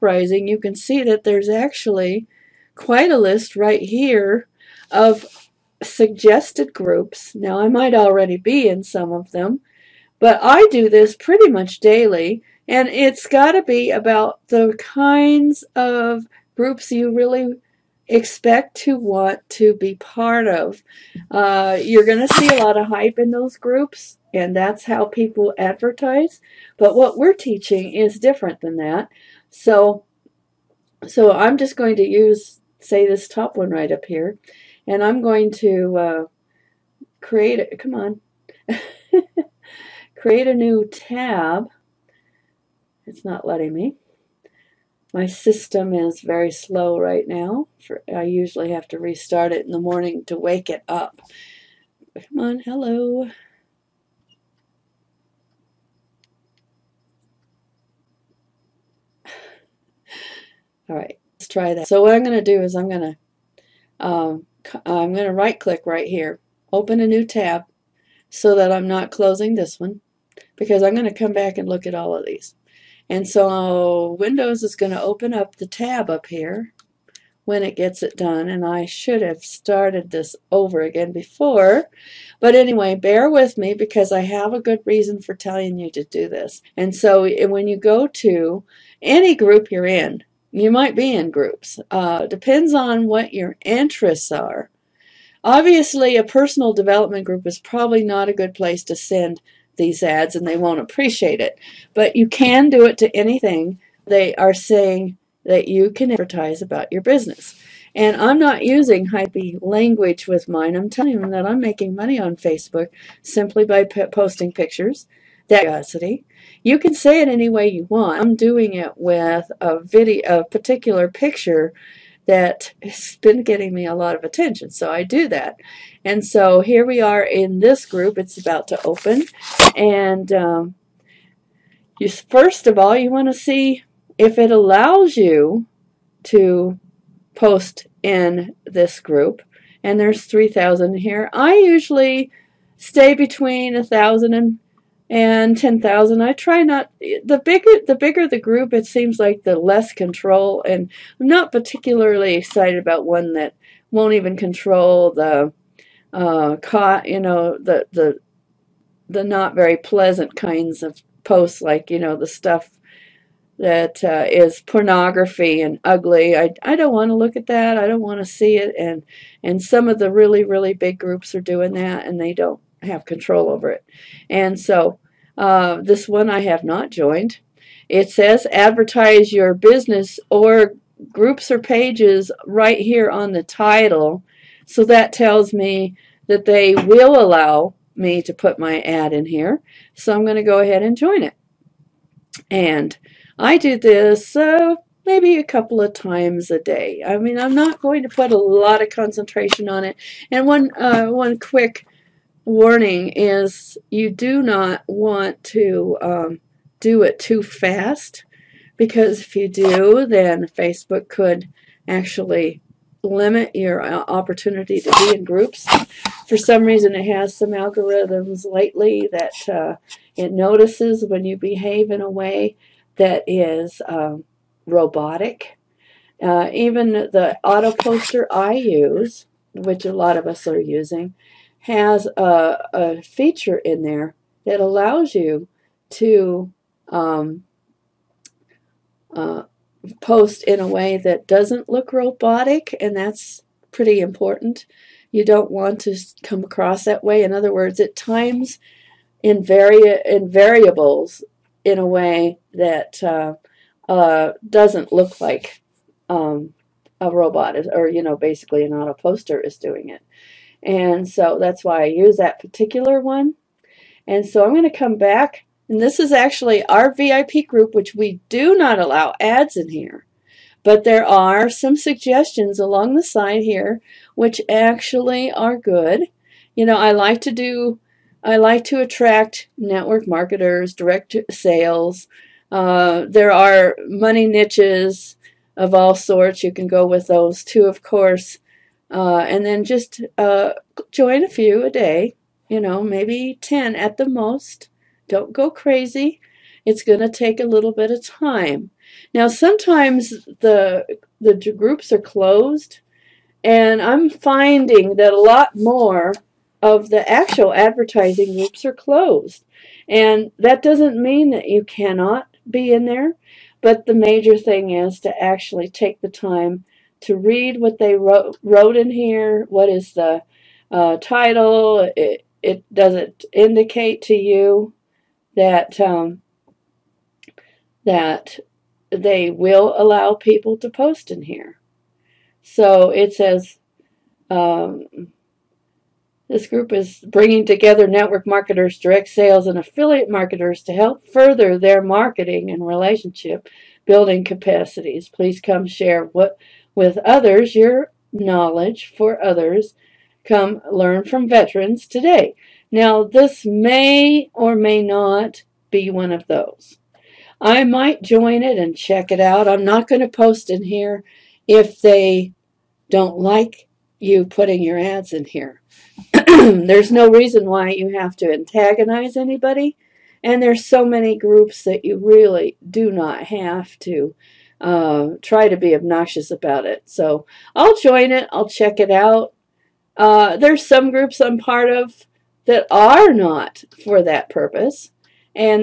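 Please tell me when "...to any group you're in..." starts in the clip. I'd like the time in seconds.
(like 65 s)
88 s.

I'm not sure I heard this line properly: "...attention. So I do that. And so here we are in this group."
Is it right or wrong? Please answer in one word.
right.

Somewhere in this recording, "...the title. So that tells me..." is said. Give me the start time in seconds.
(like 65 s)
183 s.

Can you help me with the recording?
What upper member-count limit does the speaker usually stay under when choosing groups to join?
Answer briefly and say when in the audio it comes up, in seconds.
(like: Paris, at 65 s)
10,000, at 145 s.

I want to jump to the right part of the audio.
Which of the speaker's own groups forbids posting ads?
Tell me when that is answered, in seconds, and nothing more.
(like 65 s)
266 s.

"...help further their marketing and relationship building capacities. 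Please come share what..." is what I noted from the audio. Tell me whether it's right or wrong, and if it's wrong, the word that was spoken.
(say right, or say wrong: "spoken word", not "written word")
right.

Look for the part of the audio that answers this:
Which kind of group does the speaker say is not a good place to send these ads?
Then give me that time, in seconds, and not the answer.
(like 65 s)
96 s.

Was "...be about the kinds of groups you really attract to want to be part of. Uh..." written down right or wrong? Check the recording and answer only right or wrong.
wrong.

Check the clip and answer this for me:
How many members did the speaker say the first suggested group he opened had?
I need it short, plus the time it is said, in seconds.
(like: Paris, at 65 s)
3,000, at 140 s.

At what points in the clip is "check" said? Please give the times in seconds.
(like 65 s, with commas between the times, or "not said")
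358 s, 378 s.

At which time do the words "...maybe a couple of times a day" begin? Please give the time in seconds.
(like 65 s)
195 s.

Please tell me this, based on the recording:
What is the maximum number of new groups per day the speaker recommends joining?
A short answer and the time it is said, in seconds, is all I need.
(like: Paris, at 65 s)
10, at 293 s.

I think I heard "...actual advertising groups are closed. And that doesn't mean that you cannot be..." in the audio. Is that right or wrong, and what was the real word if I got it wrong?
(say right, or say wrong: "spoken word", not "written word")
right.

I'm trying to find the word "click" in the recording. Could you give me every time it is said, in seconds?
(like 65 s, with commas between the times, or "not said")
65 s.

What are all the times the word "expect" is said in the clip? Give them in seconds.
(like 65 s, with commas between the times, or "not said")
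18 s.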